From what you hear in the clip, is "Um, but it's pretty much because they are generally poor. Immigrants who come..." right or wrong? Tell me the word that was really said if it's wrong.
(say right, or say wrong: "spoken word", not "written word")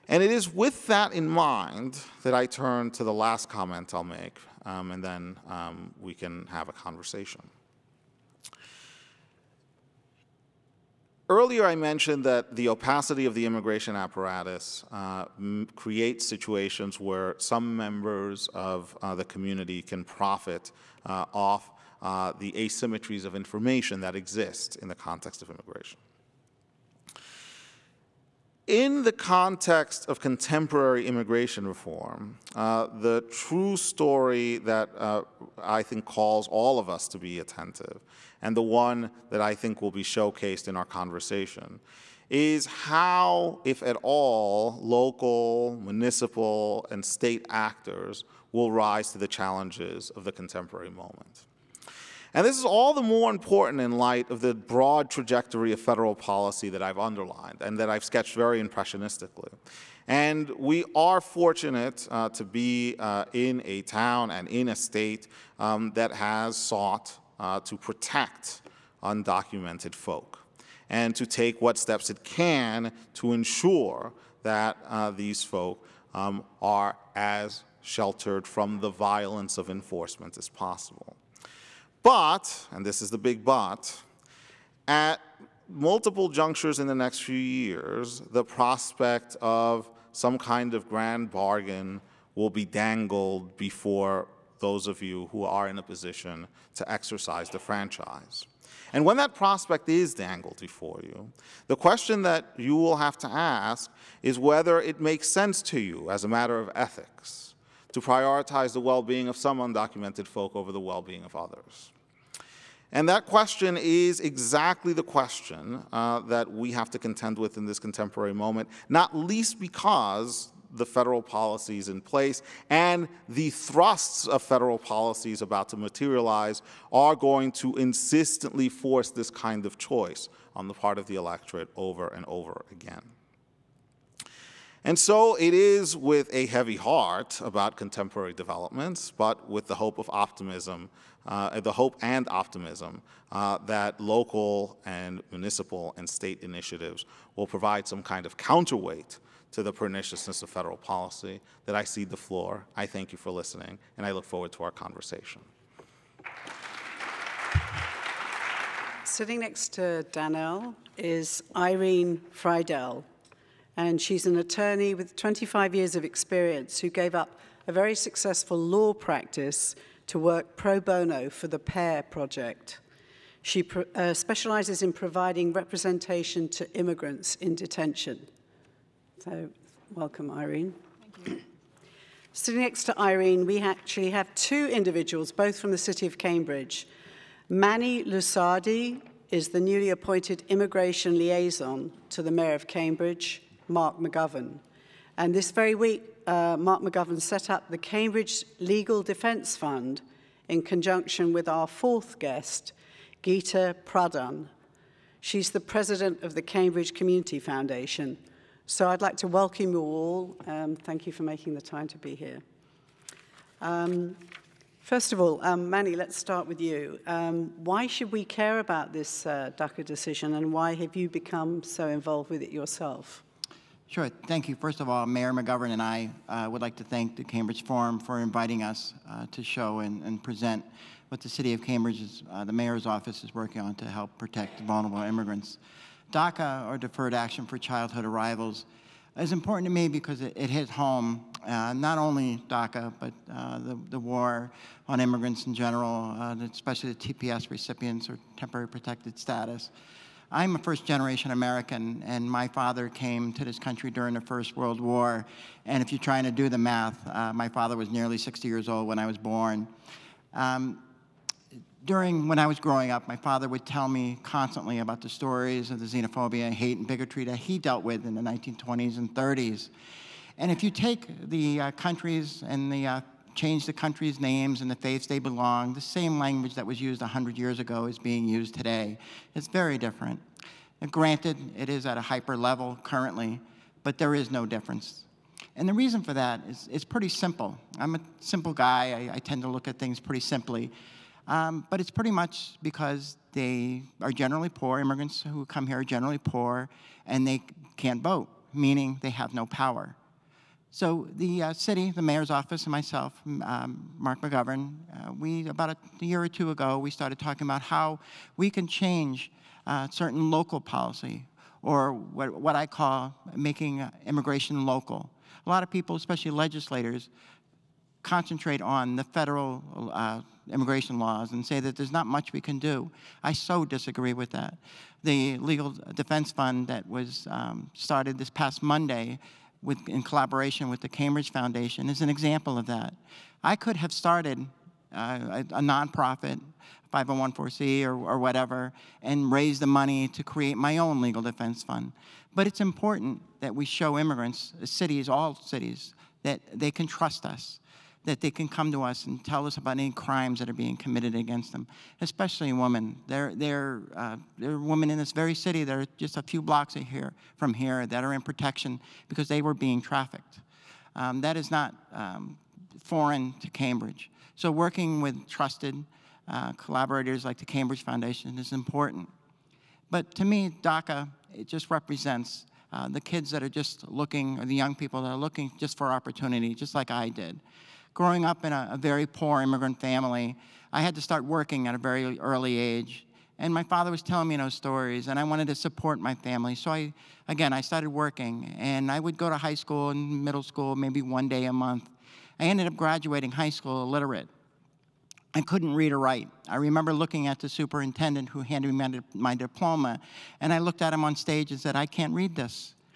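right.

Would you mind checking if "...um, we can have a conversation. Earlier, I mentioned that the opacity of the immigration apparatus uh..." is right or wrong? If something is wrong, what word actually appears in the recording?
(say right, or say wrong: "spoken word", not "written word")
right.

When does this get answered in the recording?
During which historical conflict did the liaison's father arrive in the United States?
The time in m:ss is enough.
4:14.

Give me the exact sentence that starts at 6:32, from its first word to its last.
I ended up graduating high school illiterate.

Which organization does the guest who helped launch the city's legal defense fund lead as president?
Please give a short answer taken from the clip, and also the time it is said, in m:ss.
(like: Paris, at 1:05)
Cambridge Community Foundation, at 3:26.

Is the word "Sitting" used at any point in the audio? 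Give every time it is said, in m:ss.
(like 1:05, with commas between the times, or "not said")
2:39, 3:02.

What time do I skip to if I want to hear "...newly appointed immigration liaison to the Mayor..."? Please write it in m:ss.
3:09.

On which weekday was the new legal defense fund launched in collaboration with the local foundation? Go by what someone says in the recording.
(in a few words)
Monday.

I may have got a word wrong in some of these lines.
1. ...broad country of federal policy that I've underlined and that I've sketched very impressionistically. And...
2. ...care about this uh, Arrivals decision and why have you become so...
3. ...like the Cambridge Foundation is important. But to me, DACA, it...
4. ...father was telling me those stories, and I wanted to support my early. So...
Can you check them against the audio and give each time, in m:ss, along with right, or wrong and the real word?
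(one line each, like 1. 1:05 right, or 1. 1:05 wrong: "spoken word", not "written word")
1. 0:54 wrong: "trajectory", not "country"
2. 3:38 wrong: "DACA", not "Arrivals"
3. 6:07 right
4. 6:23 wrong: "family", not "early".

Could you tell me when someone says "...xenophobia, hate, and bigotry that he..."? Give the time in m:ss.
4:25.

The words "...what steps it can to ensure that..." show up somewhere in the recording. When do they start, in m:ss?
1:11.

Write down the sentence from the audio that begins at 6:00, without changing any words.
Um, that is not um, foreign to Cambridge.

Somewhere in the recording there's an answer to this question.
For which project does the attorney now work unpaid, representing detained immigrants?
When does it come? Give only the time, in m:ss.
2:51.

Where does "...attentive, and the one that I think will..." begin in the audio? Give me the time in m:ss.
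0:37.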